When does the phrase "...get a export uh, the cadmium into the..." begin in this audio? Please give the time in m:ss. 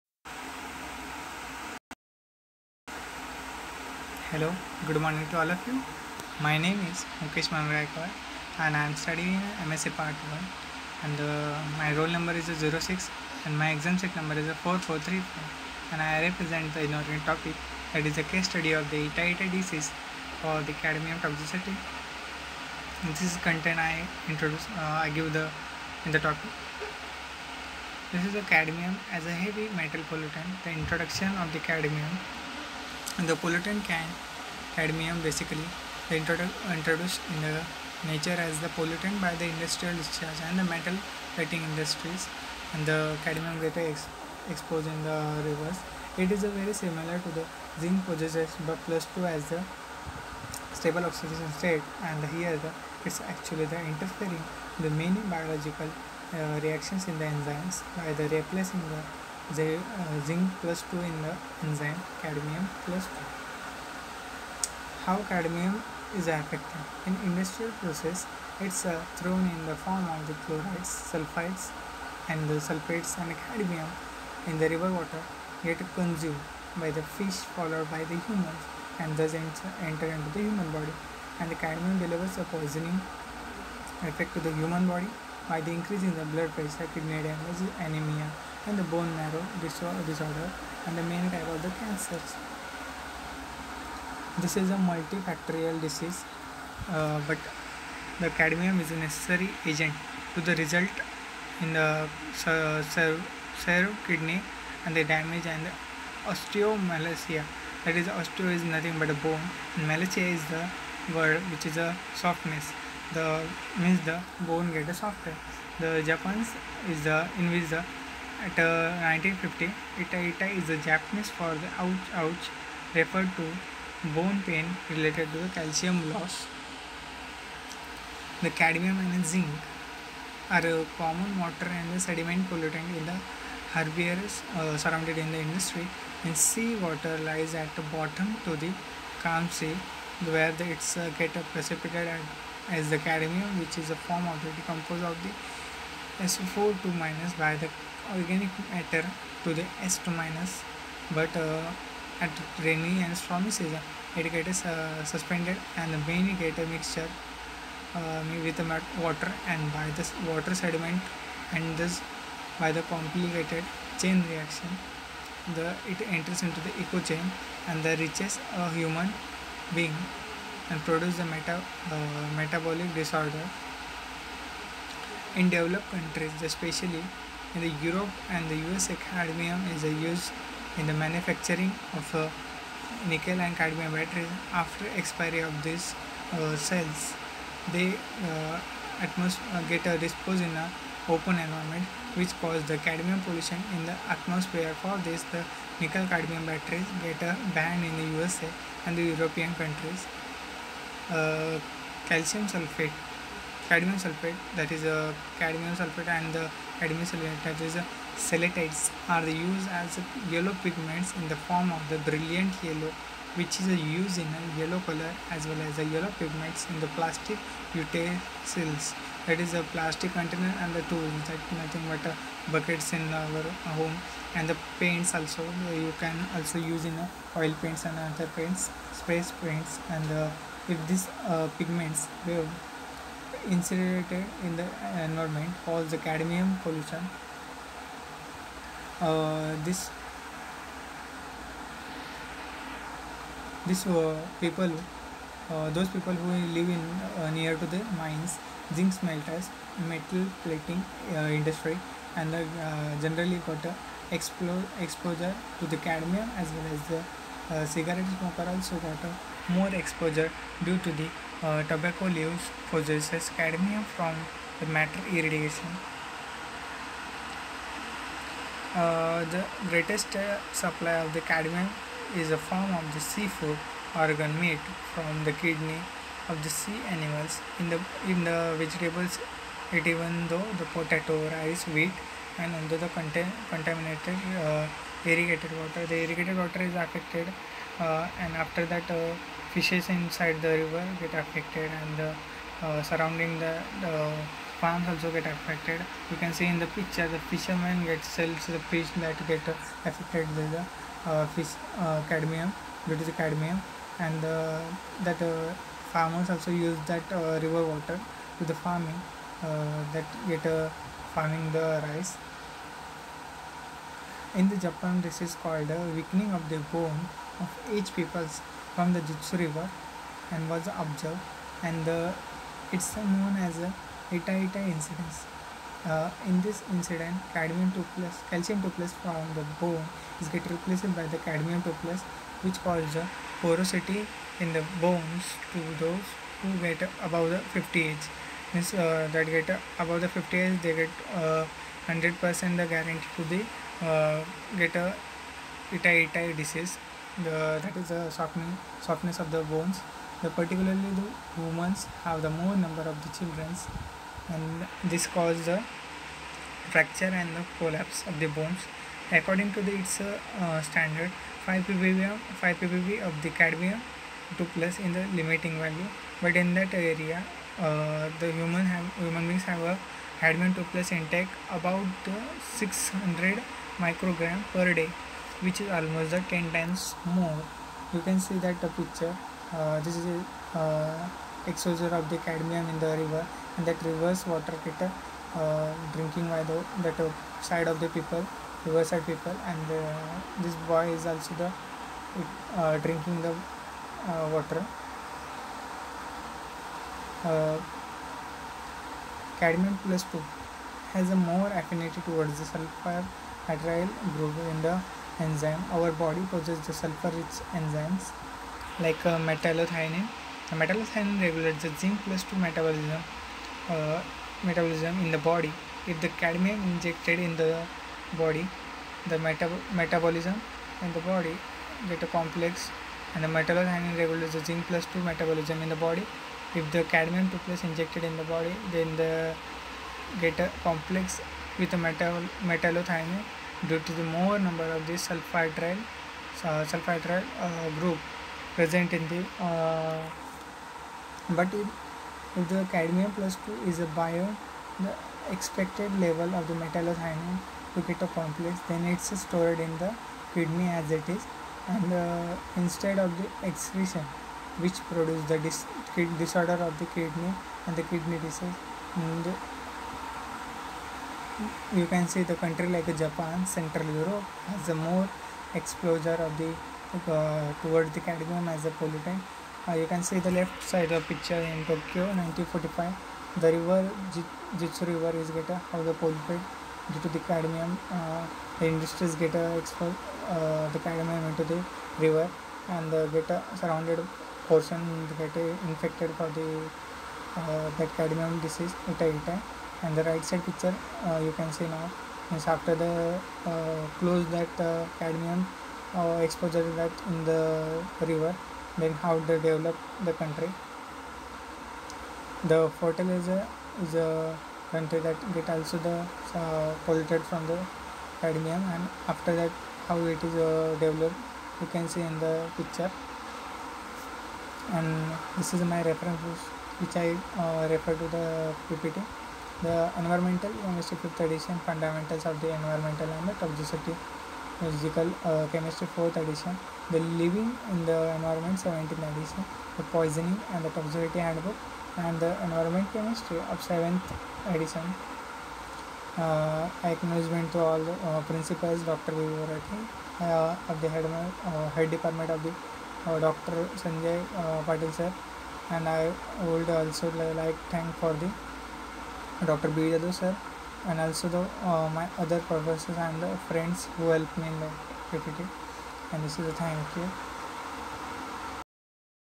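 7:59.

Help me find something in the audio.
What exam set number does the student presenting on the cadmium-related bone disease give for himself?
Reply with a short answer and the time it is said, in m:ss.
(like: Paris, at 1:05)
4434, at 0:14.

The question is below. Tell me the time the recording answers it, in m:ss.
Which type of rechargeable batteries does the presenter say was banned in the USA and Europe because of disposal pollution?
3:15.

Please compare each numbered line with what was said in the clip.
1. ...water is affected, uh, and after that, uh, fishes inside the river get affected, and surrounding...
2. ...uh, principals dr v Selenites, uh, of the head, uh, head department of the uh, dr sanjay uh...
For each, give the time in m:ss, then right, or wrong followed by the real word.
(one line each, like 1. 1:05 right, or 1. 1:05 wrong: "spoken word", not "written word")
1. 4:46 right
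2. 8:57 wrong: "Vorati", not "Selenites".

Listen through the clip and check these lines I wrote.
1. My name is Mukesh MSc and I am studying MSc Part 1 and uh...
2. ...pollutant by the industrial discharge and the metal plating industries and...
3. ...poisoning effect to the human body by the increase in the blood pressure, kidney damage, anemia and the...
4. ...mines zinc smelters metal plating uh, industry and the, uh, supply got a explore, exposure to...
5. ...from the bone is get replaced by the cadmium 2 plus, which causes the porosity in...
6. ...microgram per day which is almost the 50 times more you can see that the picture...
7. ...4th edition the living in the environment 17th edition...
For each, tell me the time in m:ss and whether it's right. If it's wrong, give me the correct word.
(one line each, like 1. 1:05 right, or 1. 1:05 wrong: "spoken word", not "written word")
1. 0:06 wrong: "Mangraikar", not "MSc"
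2. 0:38 right
3. 1:22 right
4. 4:08 wrong: "generally", not "supply"
5. 5:29 right
6. 6:13 wrong: "10", not "50"
7. 8:45 right.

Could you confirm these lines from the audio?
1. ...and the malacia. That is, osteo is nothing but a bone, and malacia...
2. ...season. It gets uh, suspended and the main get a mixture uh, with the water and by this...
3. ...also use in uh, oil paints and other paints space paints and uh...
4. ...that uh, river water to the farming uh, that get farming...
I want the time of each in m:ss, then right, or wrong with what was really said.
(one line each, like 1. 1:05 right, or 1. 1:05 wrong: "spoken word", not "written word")
1. 1:45 wrong: "osteomalacia", not "malacia"
2. 2:33 right
3. 3:46 right
4. 5:06 right.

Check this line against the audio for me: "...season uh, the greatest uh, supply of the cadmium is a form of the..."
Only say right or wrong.
wrong.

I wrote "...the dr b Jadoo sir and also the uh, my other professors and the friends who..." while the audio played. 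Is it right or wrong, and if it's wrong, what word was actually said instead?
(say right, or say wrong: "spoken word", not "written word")
right.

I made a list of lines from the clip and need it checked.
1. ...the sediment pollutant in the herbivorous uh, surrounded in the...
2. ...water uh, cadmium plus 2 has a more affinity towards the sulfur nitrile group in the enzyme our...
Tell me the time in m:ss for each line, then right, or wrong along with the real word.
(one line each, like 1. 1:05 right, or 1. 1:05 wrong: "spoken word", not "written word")
1. 2:11 right
2. 6:34 right.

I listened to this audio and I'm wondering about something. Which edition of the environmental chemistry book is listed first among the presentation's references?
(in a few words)
fifth edition.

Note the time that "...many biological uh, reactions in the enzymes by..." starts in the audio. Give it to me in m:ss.
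0:54.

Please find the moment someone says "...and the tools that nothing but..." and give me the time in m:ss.
3:40.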